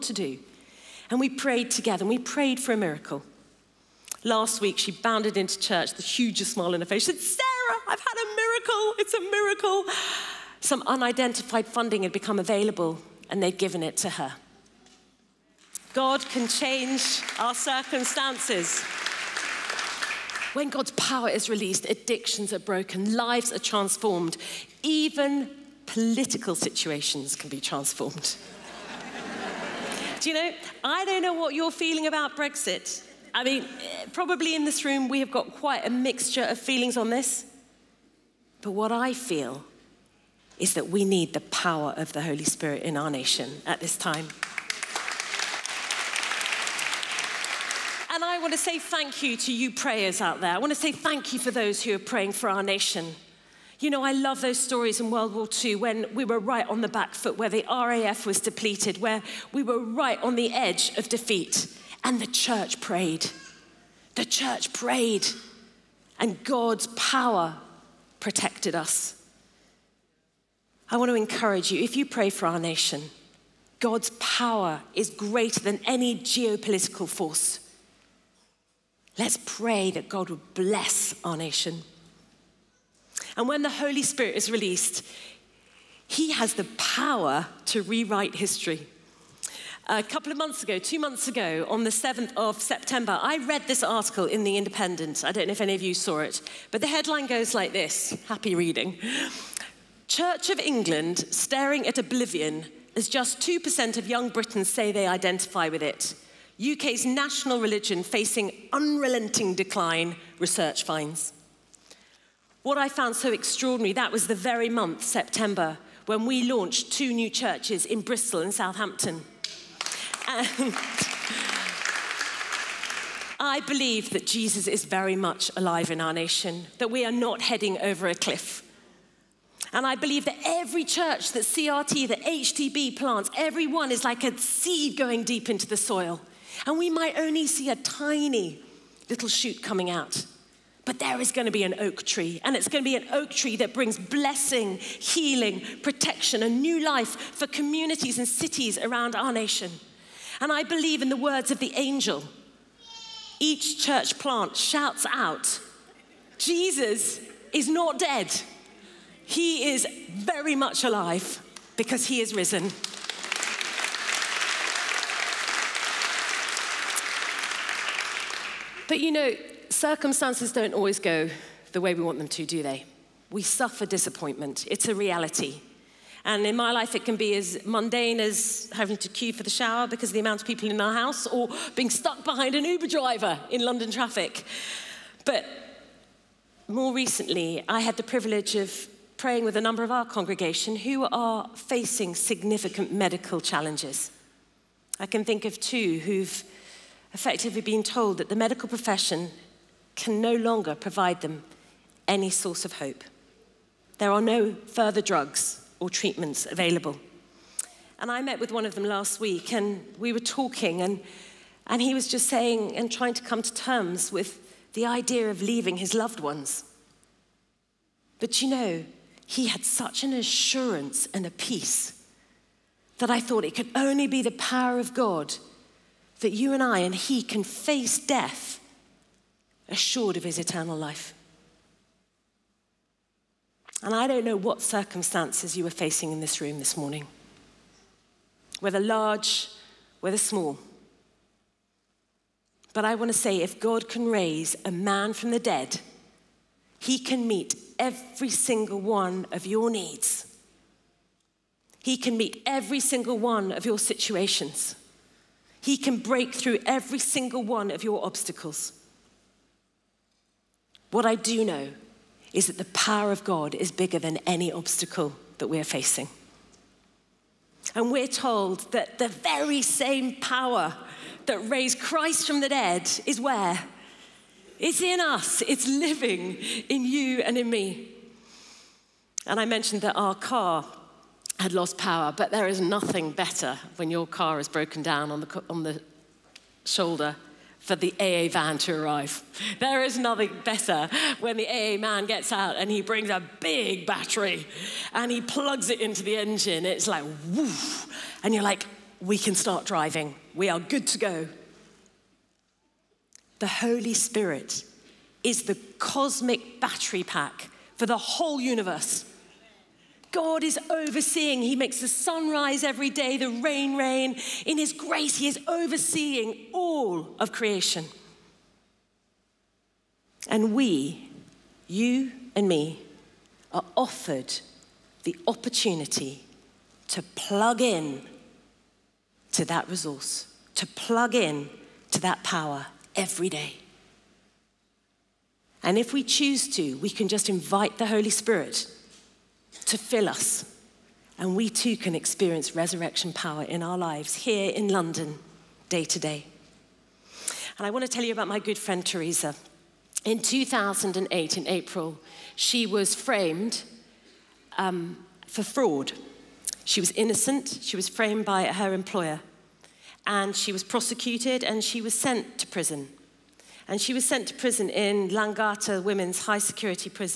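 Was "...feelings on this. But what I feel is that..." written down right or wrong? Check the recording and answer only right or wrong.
right.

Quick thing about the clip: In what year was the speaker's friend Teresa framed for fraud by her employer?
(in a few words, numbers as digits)
2008.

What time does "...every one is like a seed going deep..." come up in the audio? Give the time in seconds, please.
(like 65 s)
133 s.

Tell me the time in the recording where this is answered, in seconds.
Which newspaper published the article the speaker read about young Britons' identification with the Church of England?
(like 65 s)
94 s.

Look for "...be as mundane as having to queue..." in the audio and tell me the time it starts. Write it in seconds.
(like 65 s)
177 s.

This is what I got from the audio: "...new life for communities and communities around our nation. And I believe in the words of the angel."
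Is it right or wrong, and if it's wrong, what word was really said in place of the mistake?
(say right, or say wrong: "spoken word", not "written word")
wrong: "cities", not "communities".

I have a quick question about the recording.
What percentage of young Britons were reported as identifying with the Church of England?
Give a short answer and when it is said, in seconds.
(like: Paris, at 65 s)
2%, at 103 s.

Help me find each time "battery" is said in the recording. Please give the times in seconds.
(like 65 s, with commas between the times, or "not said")
293 s, 306 s.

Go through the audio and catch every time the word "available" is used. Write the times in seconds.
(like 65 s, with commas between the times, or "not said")
12 s, 206 s.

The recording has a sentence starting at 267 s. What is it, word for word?
And we're told that the very same power that raised Christ from the dead is where?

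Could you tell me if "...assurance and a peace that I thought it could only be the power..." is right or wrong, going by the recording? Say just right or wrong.
right.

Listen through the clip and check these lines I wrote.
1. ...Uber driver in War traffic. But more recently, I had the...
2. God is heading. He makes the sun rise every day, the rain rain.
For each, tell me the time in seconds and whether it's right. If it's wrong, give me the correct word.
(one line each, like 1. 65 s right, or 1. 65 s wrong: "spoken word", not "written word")
1. 182 s wrong: "London", not "War"
2. 310 s wrong: "overseeing", not "heading".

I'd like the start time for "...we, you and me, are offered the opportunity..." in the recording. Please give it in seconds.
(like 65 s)
320 s.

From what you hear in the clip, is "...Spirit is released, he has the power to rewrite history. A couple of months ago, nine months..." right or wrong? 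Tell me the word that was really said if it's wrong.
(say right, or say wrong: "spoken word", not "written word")
wrong: "two", not "nine".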